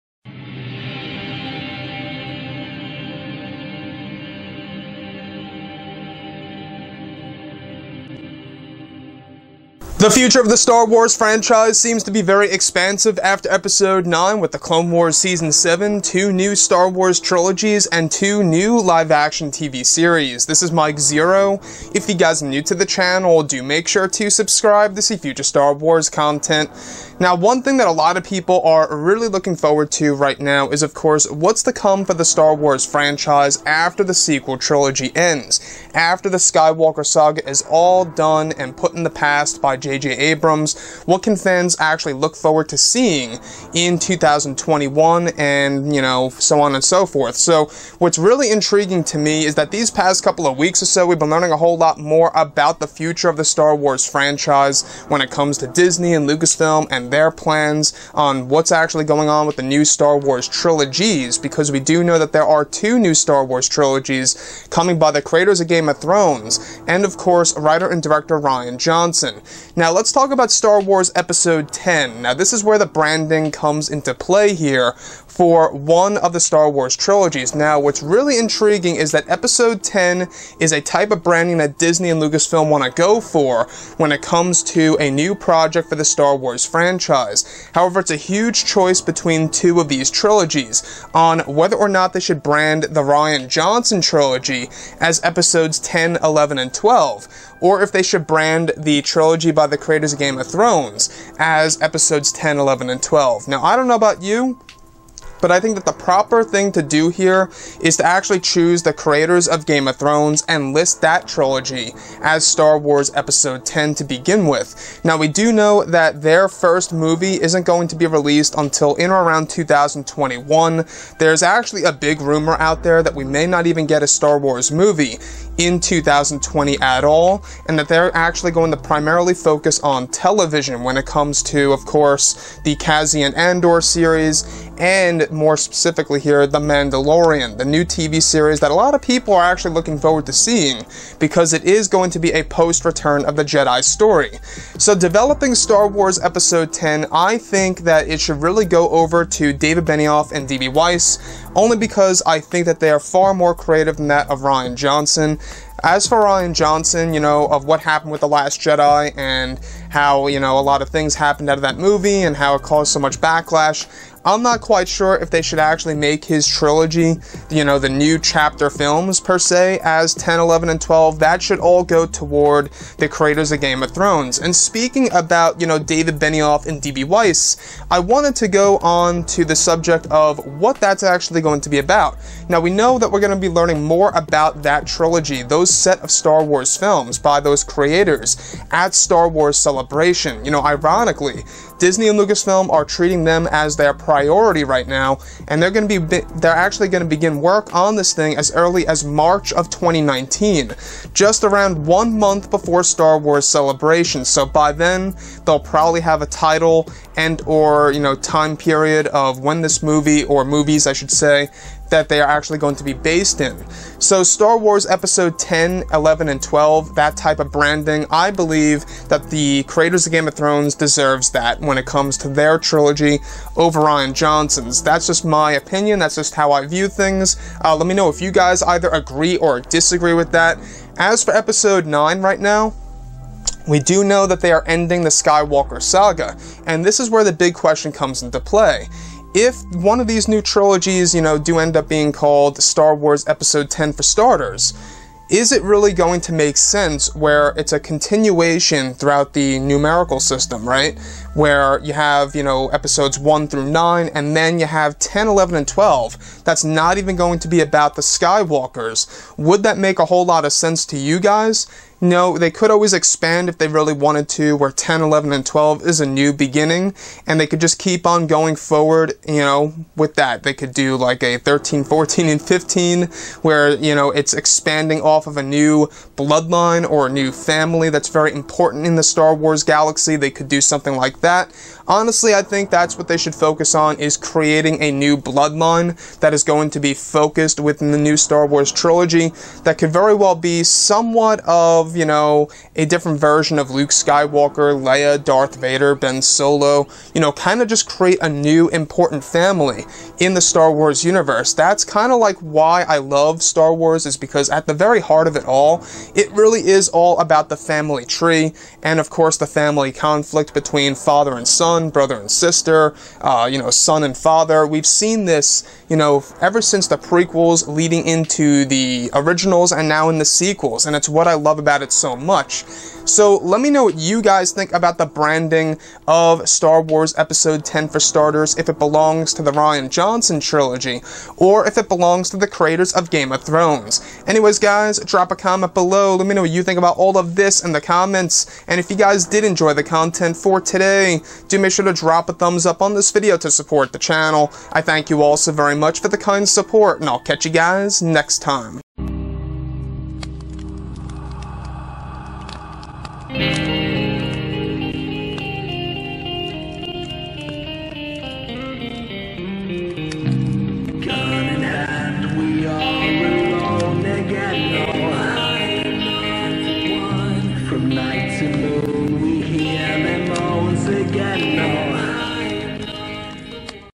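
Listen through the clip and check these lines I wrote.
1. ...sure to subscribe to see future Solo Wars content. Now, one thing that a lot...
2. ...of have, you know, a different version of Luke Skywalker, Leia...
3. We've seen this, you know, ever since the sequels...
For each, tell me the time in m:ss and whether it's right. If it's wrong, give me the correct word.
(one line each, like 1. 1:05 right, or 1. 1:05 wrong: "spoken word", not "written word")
1. 0:23 wrong: "Star", not "Solo"
2. 4:51 right
3. 5:14 wrong: "prequels", not "sequels".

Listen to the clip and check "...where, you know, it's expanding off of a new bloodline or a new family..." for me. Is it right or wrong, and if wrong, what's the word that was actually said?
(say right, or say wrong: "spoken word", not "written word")
right.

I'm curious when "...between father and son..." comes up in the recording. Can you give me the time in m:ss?
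5:10.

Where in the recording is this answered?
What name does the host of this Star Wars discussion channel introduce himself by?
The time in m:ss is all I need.
0:20.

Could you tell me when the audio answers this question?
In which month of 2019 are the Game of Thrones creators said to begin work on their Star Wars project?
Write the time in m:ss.
3:19.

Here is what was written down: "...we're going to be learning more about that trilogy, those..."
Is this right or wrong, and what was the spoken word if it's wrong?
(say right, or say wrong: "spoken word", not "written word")
right.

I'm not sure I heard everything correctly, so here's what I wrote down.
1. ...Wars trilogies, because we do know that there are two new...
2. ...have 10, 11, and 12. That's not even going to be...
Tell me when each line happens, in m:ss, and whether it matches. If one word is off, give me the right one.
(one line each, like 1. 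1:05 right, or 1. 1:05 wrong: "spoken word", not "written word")
1. 1:00 right
2. 4:14 right.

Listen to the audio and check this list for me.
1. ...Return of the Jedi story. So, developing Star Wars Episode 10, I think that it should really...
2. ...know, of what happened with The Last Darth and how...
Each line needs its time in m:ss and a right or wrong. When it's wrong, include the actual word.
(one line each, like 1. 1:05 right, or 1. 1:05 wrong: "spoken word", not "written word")
1. 2:22 right
2. 2:37 wrong: "Jedi", not "Darth".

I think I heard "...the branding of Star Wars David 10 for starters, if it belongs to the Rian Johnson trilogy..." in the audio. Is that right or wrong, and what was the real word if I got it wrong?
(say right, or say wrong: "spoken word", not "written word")
wrong: "Episode", not "David".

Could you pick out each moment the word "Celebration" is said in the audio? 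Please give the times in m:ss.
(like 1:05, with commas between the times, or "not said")
3:09, 3:23.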